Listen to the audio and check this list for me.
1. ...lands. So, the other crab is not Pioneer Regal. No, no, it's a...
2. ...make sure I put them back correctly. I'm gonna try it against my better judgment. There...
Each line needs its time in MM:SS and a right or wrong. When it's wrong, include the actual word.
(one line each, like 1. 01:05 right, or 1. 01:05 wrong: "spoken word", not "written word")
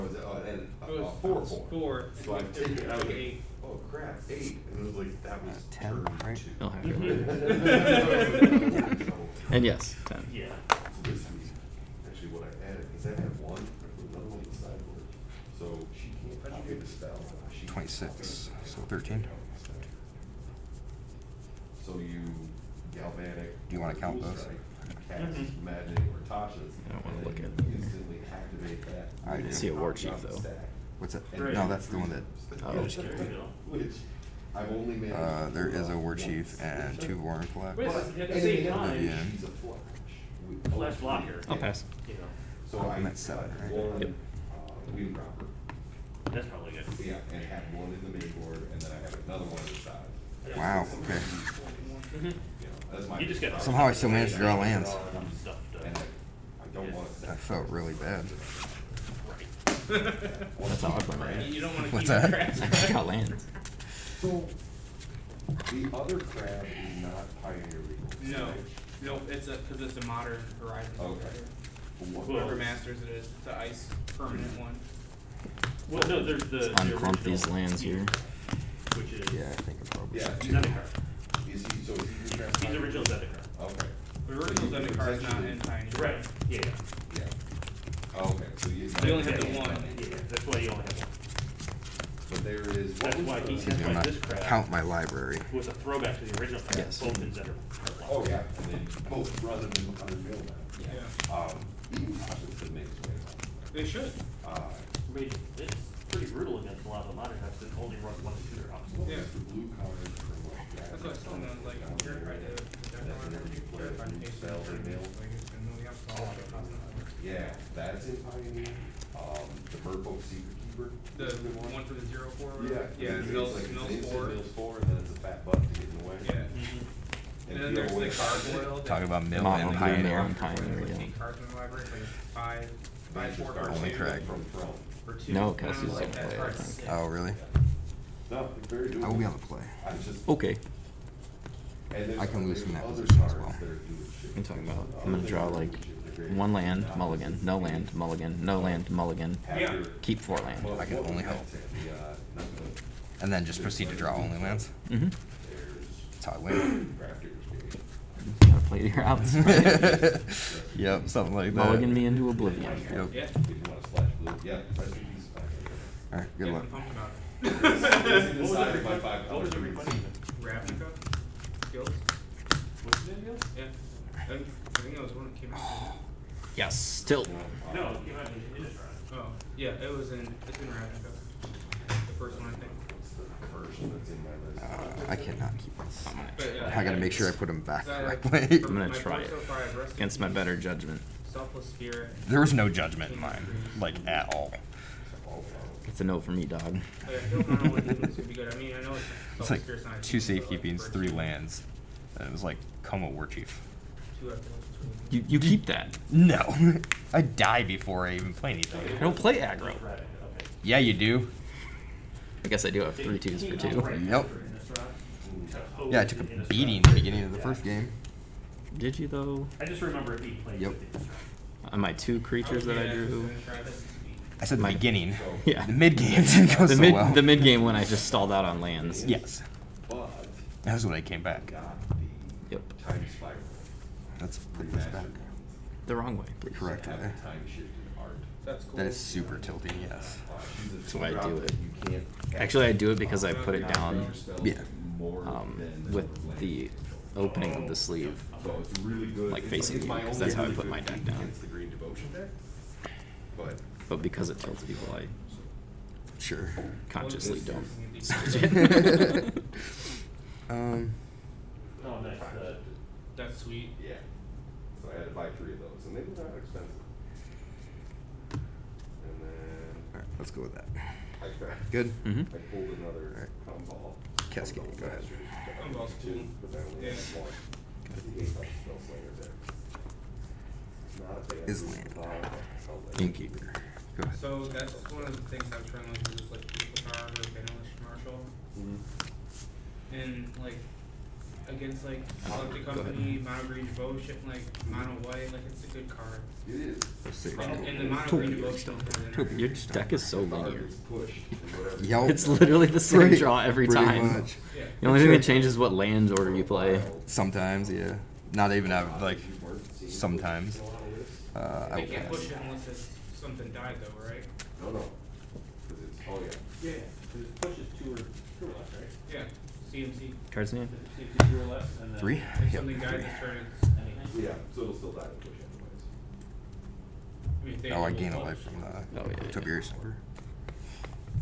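1. 01:03 right
2. 03:06 right.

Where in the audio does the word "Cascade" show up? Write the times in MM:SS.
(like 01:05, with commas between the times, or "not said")
04:34.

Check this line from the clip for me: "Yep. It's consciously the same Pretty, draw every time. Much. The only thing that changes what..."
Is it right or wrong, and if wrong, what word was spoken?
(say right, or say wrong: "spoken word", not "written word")
wrong: "literally", not "consciously".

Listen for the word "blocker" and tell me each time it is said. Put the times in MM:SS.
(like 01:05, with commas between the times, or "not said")
00:40.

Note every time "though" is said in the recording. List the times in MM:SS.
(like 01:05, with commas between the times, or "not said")
00:30, 03:39, 05:13.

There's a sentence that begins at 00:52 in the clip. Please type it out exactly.
Mhm just Somehow I still managed to draw lands.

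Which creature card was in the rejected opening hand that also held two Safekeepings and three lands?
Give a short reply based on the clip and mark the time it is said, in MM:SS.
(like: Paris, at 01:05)
Koma War Chief, at 03:22.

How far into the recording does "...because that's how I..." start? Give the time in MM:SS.
04:09.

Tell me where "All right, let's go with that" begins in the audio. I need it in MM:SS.
04:29.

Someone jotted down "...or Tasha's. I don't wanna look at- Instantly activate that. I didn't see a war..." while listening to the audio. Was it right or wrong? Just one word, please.
right.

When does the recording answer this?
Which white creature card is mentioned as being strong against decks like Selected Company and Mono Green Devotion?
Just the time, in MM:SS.
04:47.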